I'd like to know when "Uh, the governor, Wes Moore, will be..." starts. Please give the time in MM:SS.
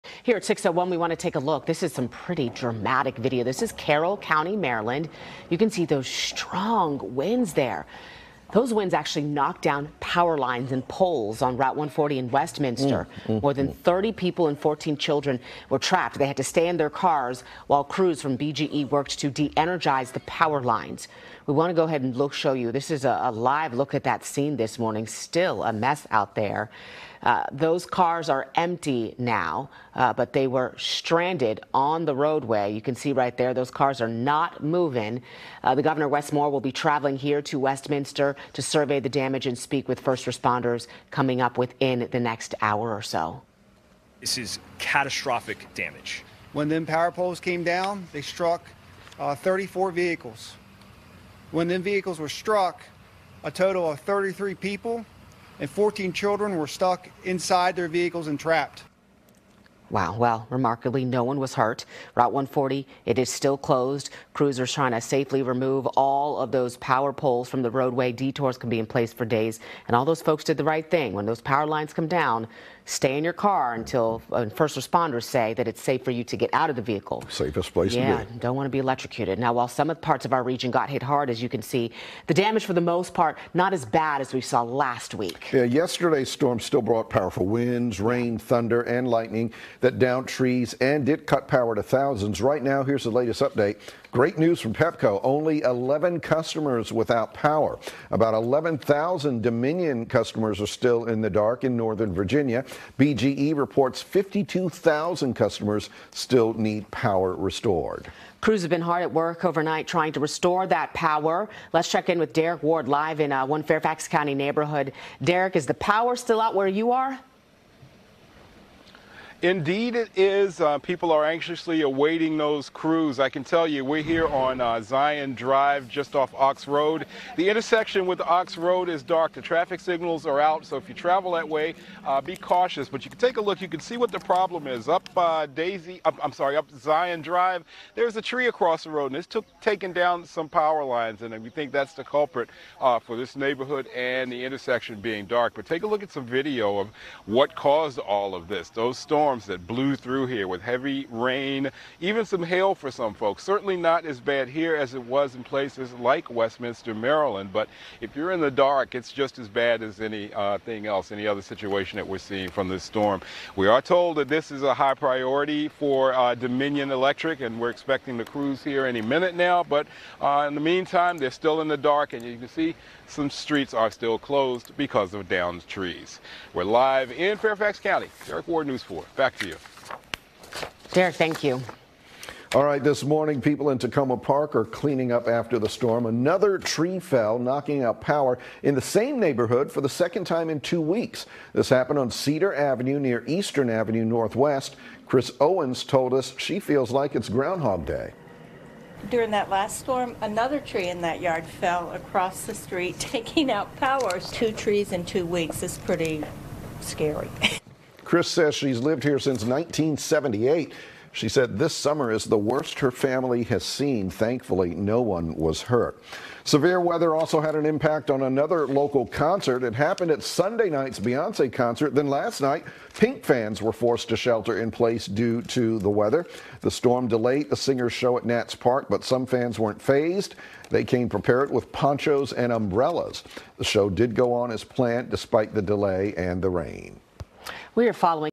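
00:35.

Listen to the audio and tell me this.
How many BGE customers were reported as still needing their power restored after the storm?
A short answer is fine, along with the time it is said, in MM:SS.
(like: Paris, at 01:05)
52,000, at 01:44.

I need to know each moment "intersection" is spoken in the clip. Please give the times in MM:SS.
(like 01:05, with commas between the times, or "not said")
02:07, 02:24.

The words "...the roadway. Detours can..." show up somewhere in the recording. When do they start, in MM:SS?
01:07.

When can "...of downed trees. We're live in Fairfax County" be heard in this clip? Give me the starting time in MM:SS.
02:55.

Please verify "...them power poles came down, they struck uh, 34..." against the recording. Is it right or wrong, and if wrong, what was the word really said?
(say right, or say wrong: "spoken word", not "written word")
right.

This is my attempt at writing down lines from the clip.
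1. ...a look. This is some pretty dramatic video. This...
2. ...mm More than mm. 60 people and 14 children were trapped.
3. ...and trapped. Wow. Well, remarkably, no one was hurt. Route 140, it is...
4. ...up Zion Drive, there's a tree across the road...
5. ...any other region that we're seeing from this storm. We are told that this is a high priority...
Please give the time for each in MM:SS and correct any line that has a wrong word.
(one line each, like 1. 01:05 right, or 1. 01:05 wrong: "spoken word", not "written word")
1. 00:01 right
2. 00:13 wrong: "30", not "60"
3. 00:58 right
4. 02:16 right
5. 02:41 wrong: "situation", not "region".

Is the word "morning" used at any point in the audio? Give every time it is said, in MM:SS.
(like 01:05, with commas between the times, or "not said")
00:24, 03:03.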